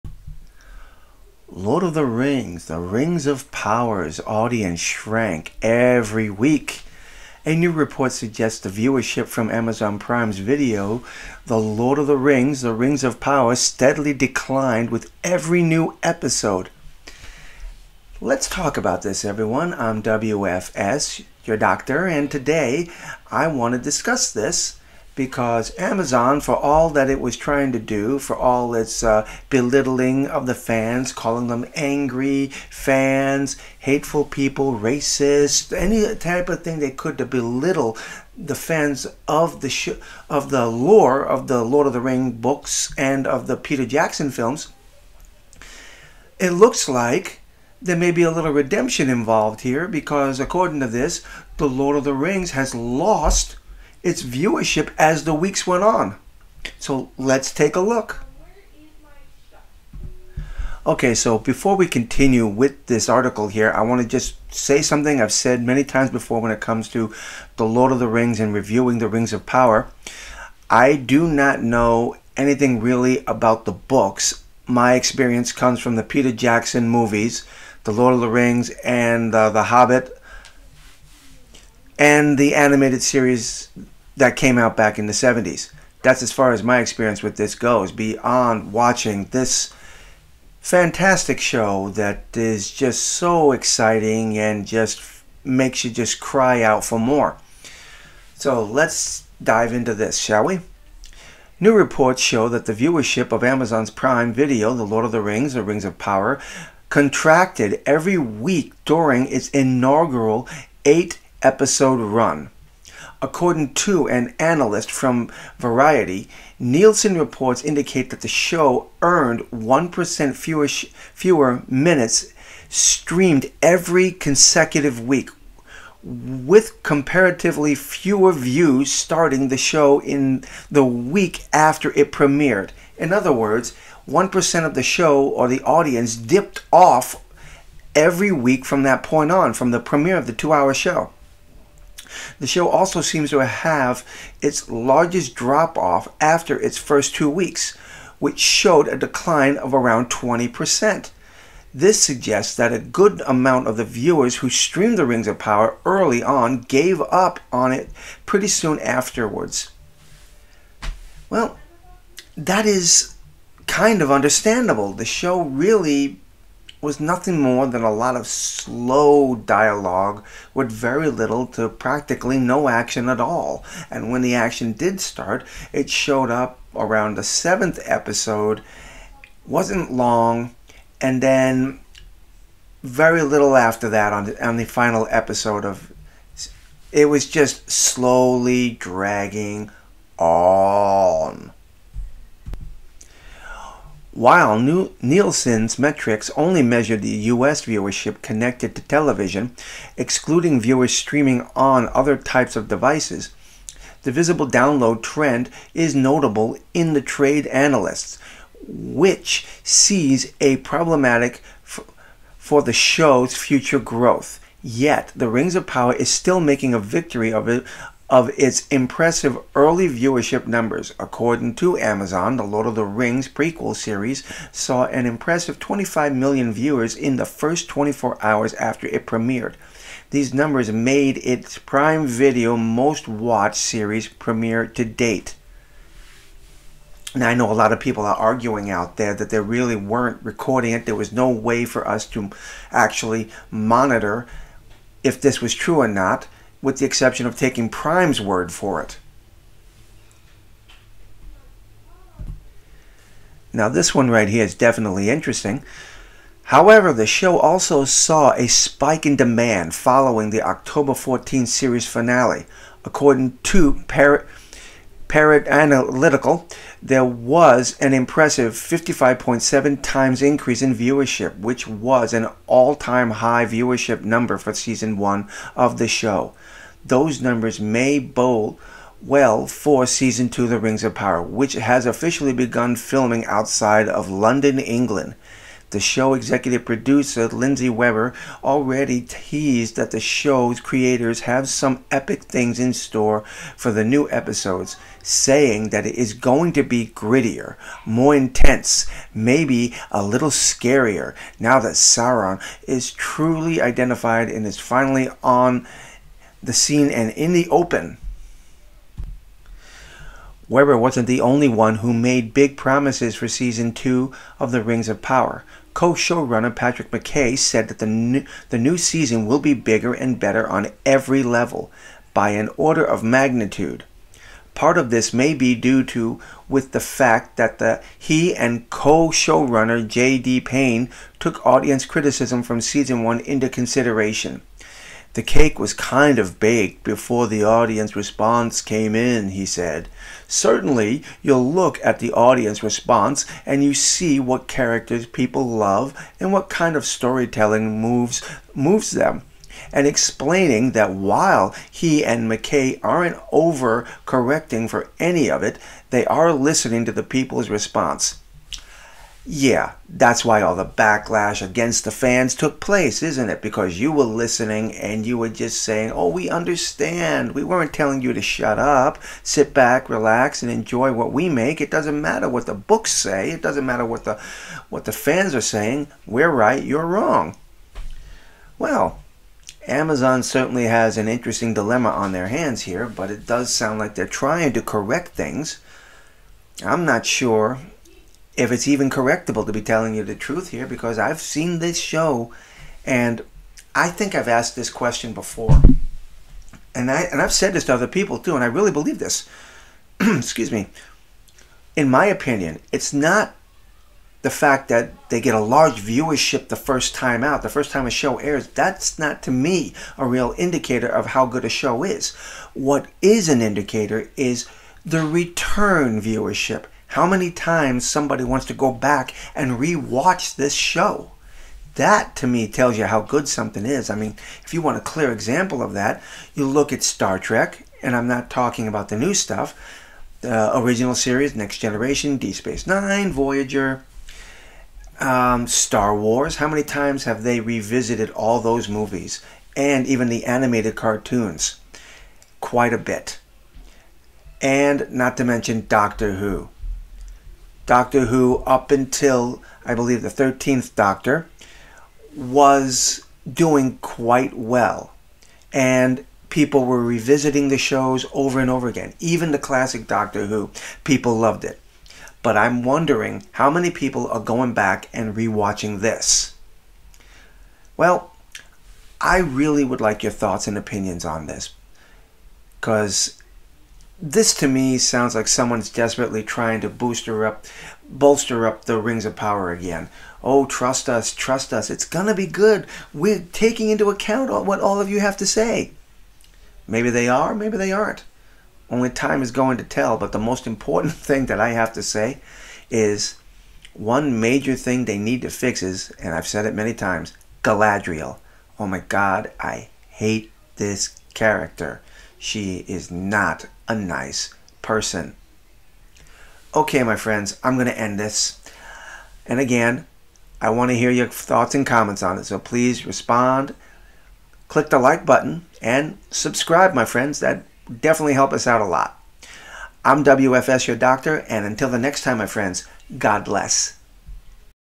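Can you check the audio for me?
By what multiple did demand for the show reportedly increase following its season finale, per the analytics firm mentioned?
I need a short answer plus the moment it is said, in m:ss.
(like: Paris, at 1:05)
55.7 times, at 4:28.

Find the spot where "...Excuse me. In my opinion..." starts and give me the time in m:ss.
6:39.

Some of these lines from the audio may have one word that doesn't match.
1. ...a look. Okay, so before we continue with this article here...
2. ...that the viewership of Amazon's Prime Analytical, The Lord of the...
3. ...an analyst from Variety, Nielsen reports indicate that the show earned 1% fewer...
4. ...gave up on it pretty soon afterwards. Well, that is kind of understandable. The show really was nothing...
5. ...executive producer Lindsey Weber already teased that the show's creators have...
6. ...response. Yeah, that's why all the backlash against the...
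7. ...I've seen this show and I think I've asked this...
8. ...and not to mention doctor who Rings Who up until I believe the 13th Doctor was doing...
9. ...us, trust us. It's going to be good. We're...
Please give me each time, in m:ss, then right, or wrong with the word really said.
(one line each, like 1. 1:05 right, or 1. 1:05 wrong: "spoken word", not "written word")
1. 0:57 right
2. 1:42 wrong: "Video", not "Analytical"
3. 1:54 right
4. 2:36 right
5. 4:46 right
6. 5:57 right
7. 6:30 right
8. 7:24 wrong: "Doctor", not "Rings"
9. 8:00 right.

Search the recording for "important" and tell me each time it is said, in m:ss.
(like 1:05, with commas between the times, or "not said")
8:10.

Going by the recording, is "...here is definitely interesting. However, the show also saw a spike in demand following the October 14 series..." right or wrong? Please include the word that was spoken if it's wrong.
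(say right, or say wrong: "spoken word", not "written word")
right.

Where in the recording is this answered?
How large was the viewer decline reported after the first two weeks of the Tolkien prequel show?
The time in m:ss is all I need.
2:29.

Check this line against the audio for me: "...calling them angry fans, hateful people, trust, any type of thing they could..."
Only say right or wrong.
wrong.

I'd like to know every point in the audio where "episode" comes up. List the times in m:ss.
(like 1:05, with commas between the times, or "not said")
0:16, 1:51, 2:57, 3:05, 4:54.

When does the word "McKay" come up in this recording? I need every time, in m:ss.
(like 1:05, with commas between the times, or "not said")
5:16, 5:52.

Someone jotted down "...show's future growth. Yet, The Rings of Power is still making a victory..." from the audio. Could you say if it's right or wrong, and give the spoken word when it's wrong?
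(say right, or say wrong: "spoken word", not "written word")
right.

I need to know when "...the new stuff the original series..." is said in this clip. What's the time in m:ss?
7:08.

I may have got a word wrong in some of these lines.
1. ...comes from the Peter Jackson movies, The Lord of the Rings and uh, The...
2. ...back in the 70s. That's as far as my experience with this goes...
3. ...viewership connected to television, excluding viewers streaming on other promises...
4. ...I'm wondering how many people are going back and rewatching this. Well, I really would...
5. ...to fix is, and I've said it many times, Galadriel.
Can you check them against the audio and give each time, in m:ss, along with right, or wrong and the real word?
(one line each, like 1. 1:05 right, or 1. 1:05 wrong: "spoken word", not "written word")
1. 1:15 right
2. 1:24 right
3. 3:17 wrong: "types", not "promises"
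4. 7:42 right
5. 8:15 right.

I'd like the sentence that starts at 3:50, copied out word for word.
These numbers made its Prime Video most watched series premiere to date.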